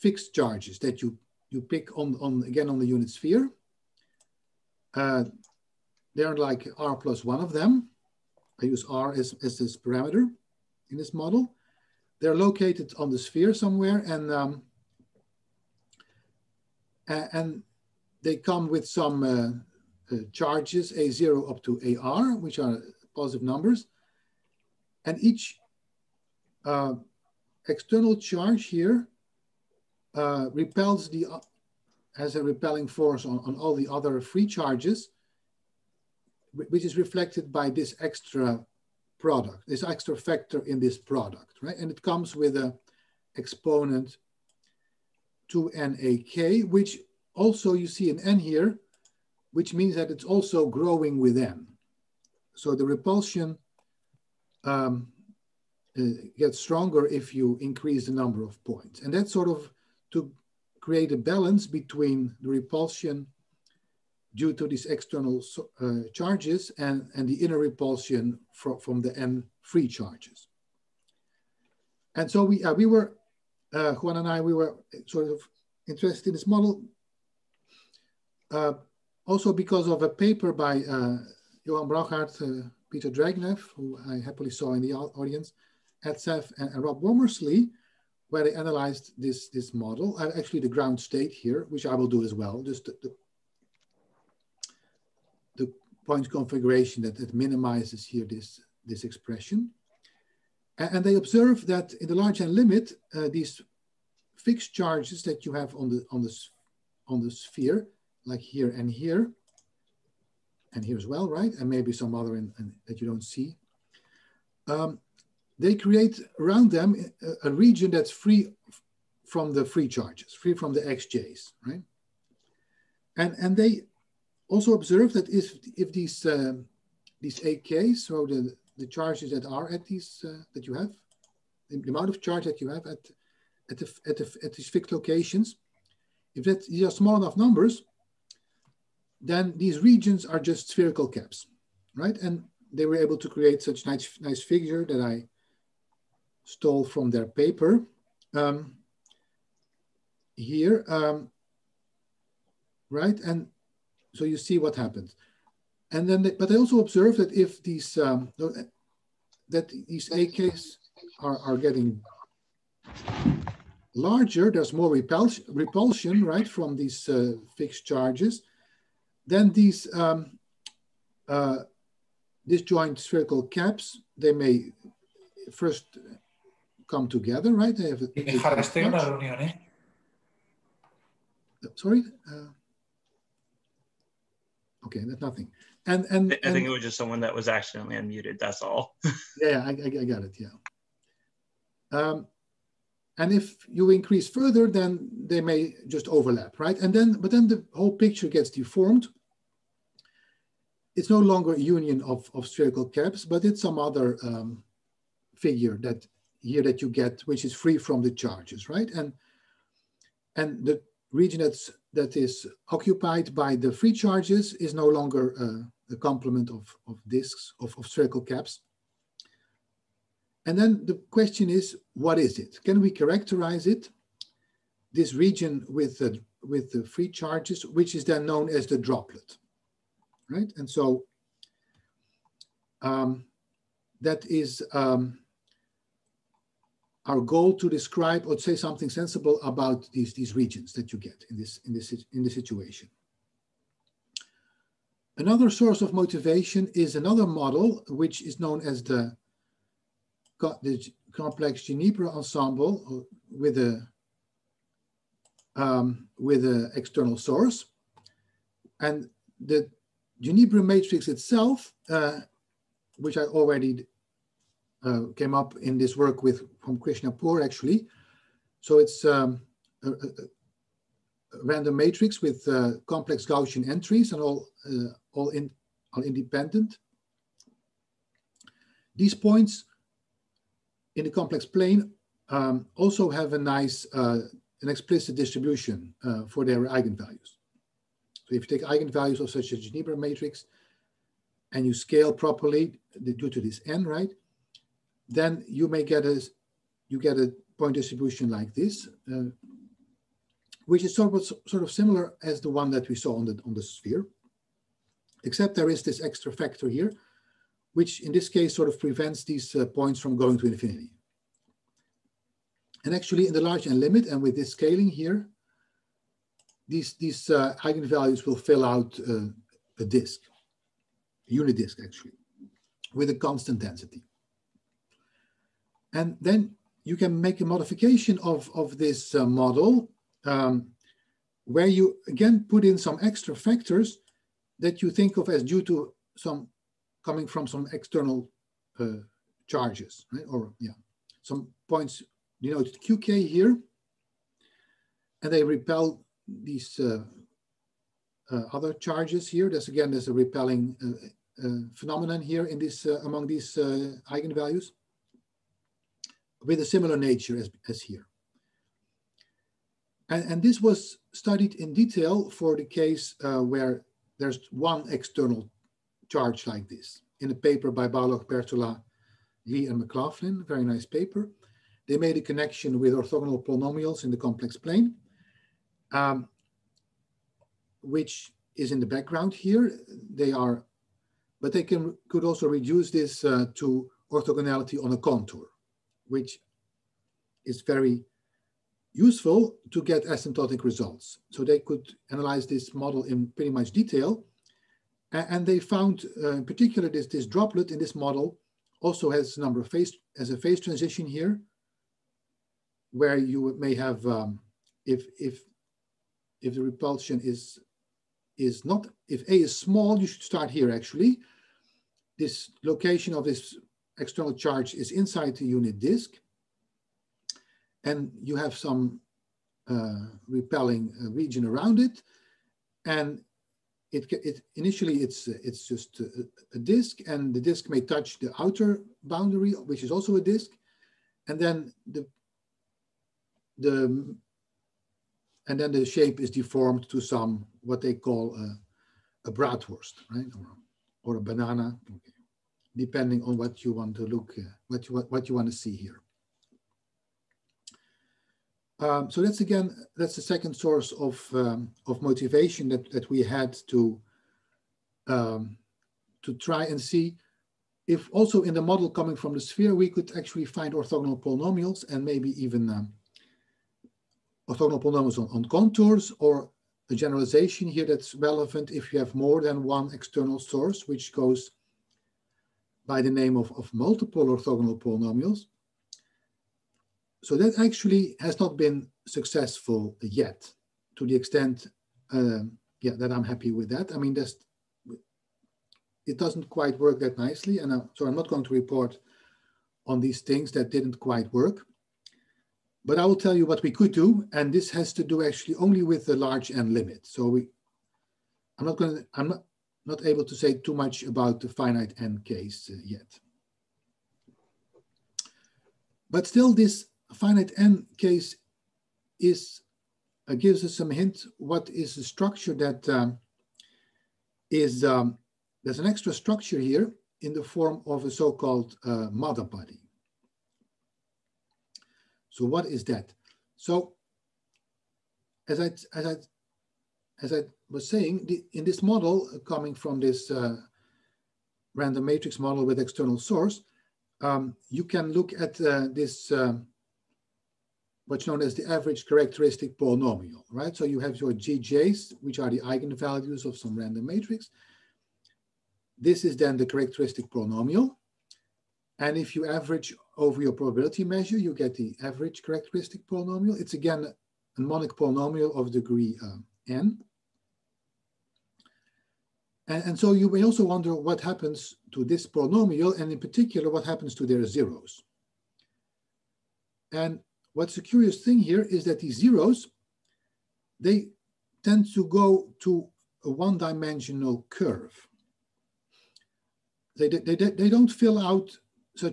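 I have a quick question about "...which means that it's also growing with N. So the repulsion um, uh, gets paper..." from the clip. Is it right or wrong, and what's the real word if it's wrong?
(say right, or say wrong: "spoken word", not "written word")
wrong: "stronger", not "paper".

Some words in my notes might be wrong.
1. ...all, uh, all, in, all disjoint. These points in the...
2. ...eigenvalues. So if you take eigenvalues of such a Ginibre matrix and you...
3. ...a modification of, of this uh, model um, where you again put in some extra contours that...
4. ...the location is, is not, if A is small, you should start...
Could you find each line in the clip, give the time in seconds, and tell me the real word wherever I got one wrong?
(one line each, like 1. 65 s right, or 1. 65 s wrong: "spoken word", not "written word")
1. 274 s wrong: "independent", not "disjoint"
2. 286 s right
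3. 327 s wrong: "factors", not "contours"
4. 406 s wrong: "repulsion", not "location".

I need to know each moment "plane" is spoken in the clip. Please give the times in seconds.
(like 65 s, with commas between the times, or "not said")
281 s, 374 s.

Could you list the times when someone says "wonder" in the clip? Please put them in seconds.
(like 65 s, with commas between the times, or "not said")
560 s.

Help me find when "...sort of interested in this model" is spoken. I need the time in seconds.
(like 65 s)
75 s.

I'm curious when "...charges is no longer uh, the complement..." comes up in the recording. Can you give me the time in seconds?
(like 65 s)
213 s.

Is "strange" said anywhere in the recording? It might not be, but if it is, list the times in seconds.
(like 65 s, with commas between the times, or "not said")
not said.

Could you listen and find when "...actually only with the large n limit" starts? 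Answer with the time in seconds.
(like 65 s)
495 s.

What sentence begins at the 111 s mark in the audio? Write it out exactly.
And maybe some other in, in, that you don't see.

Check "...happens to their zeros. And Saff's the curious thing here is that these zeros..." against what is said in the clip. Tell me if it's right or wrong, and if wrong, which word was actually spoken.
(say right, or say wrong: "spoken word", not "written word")
wrong: "What", not "Saff".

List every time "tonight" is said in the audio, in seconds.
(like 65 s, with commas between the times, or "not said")
not said.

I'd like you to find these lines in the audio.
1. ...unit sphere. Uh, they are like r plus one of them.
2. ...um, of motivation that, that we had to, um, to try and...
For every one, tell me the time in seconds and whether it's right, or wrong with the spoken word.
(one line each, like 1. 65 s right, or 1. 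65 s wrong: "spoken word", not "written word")
1. 2 s right
2. 451 s right.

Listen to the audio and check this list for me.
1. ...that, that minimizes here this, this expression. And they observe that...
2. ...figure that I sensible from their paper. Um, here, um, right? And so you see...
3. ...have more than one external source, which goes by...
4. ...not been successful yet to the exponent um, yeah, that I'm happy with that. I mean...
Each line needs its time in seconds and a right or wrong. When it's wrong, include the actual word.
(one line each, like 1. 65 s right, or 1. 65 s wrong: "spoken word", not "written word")
1. 97 s right
2. 144 s wrong: "stole", not "sensible"
3. 468 s right
4. 478 s wrong: "extent", not "exponent".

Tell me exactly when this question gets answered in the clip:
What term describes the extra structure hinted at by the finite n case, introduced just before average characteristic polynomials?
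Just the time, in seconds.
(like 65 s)
519 s.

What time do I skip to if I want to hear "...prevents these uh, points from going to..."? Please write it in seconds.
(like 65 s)
308 s.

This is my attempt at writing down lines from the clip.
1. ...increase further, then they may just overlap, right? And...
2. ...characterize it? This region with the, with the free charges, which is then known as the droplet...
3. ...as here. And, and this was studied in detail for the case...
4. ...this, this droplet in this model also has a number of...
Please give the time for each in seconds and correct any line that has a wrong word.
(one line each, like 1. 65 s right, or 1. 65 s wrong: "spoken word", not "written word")
1. 193 s right
2. 222 s right
3. 357 s right
4. 396 s right.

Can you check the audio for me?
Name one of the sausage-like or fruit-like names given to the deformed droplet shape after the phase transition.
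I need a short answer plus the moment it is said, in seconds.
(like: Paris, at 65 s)
Bratwurst, at 439 s.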